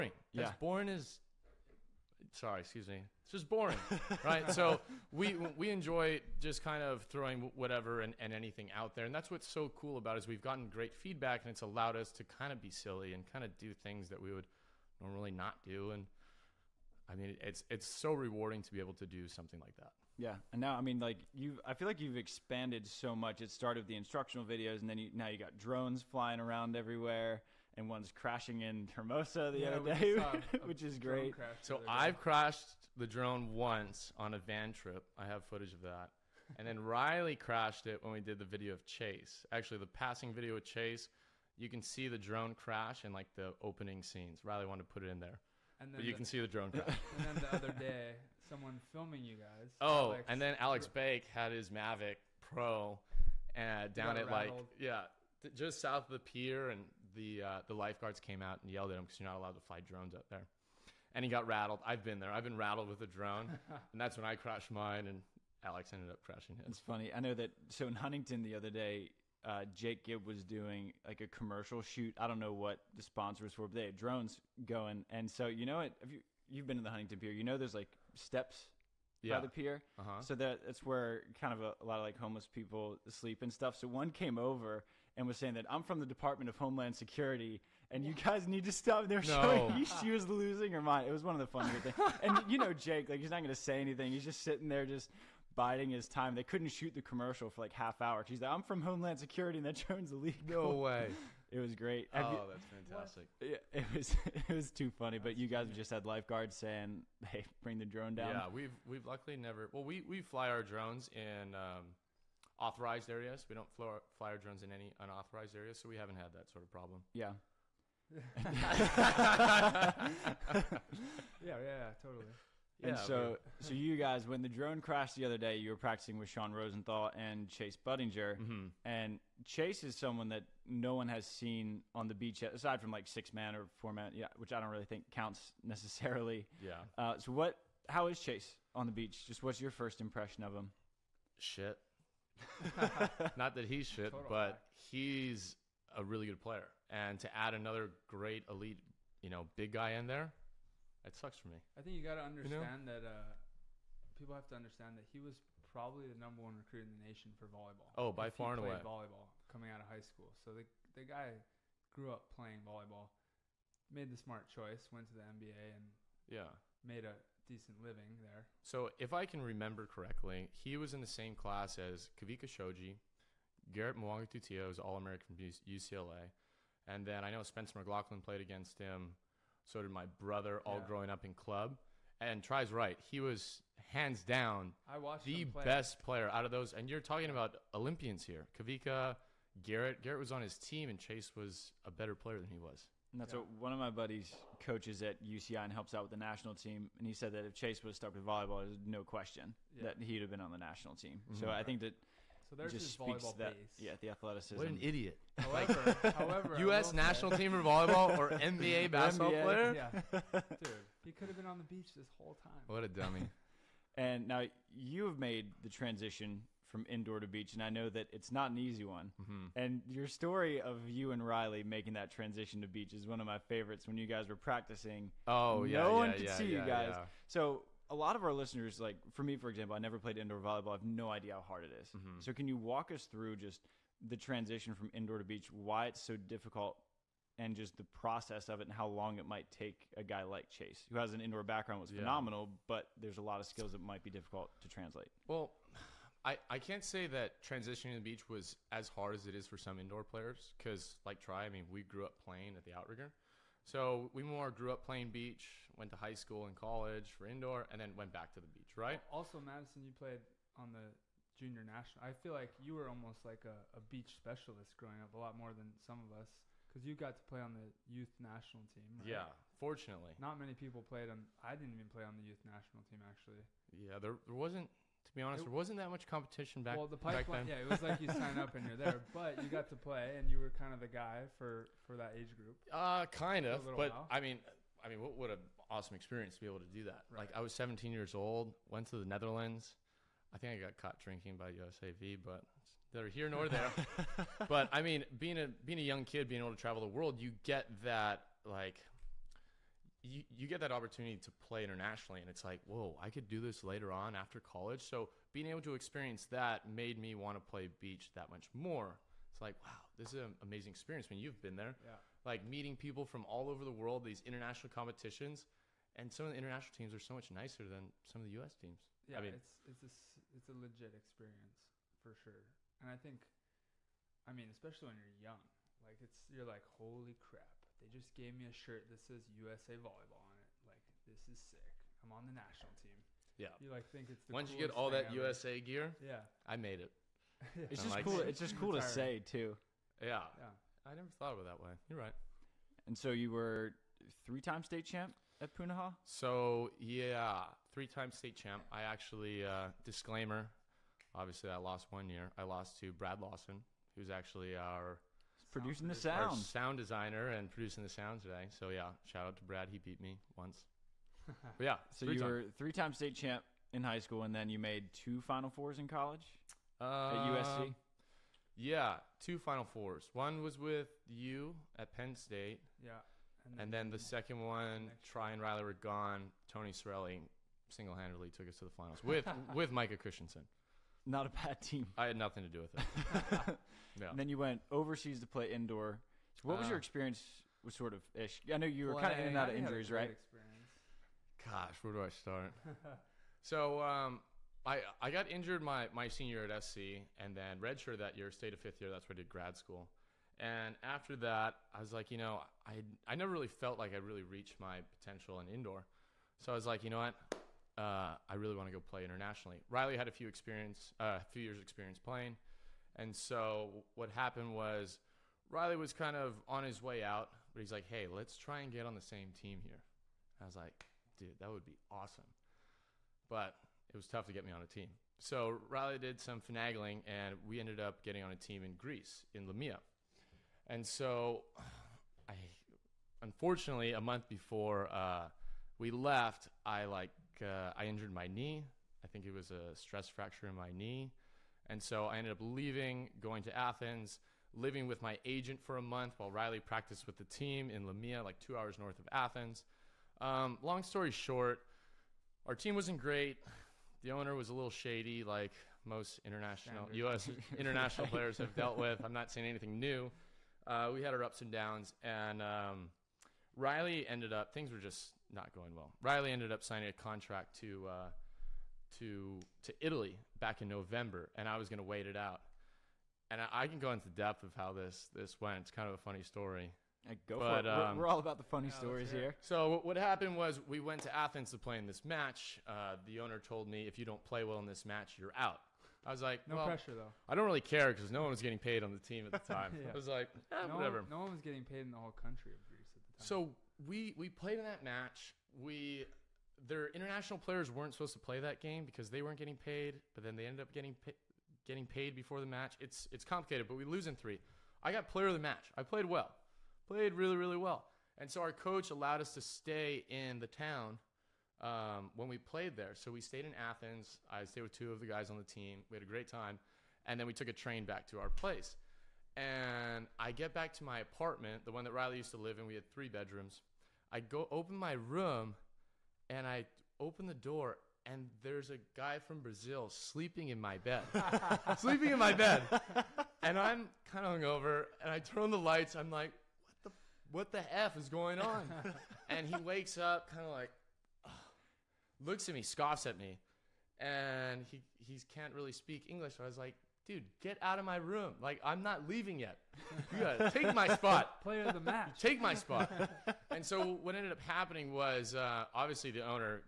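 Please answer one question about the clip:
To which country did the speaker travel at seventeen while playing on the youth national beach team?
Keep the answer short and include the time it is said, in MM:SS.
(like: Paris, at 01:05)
Netherlands, at 04:49.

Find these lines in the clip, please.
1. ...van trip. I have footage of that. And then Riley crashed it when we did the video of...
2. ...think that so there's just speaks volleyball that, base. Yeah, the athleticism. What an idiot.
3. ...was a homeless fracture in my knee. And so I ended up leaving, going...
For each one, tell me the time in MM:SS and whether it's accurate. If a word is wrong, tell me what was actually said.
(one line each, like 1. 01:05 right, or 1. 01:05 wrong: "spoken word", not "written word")
1. 00:34 right
2. 03:21 right
3. 07:19 wrong: "stress", not "homeless".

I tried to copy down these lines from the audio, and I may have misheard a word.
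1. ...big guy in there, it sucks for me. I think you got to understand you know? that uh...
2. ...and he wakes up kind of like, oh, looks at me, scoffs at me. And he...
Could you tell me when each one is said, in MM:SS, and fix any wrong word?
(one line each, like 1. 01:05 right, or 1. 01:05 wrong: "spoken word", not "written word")
1. 02:29 right
2. 08:59 right.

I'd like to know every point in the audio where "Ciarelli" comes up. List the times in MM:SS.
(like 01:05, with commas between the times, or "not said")
06:16.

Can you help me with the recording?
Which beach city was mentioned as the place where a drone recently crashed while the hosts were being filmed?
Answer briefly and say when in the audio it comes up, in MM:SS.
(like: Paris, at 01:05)
Hermosa, at 00:28.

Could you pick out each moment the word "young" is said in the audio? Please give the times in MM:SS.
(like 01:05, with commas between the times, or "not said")
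04:55, 05:25.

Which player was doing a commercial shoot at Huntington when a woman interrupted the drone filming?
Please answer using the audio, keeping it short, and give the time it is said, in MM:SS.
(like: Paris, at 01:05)
Jake Gibb, at 01:09.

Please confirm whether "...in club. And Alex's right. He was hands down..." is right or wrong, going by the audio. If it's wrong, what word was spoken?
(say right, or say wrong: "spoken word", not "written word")
wrong: "Tri", not "Alex".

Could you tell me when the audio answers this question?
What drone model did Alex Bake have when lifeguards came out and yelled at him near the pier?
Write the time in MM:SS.
00:51.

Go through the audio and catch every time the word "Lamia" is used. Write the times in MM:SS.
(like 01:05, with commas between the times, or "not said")
07:09, 07:27.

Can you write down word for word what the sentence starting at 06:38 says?
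That's where I did grad school.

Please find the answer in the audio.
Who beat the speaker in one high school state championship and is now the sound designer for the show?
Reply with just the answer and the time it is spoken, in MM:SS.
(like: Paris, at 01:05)
Brad Lawson, at 05:52.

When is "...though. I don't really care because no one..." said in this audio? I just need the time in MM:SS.
08:06.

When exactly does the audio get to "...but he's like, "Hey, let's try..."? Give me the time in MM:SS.
06:57.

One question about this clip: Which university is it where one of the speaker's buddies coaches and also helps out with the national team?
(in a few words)
UCI.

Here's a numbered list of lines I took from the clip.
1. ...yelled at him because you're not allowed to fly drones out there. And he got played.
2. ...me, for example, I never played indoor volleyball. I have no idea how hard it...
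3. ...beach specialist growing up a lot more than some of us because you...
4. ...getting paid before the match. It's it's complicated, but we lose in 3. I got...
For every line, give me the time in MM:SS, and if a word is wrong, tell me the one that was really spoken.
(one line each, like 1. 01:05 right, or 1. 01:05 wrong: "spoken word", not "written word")
1. 00:58 wrong: "rattled", not "played"
2. 03:49 right
3. 04:23 right
4. 08:21 right.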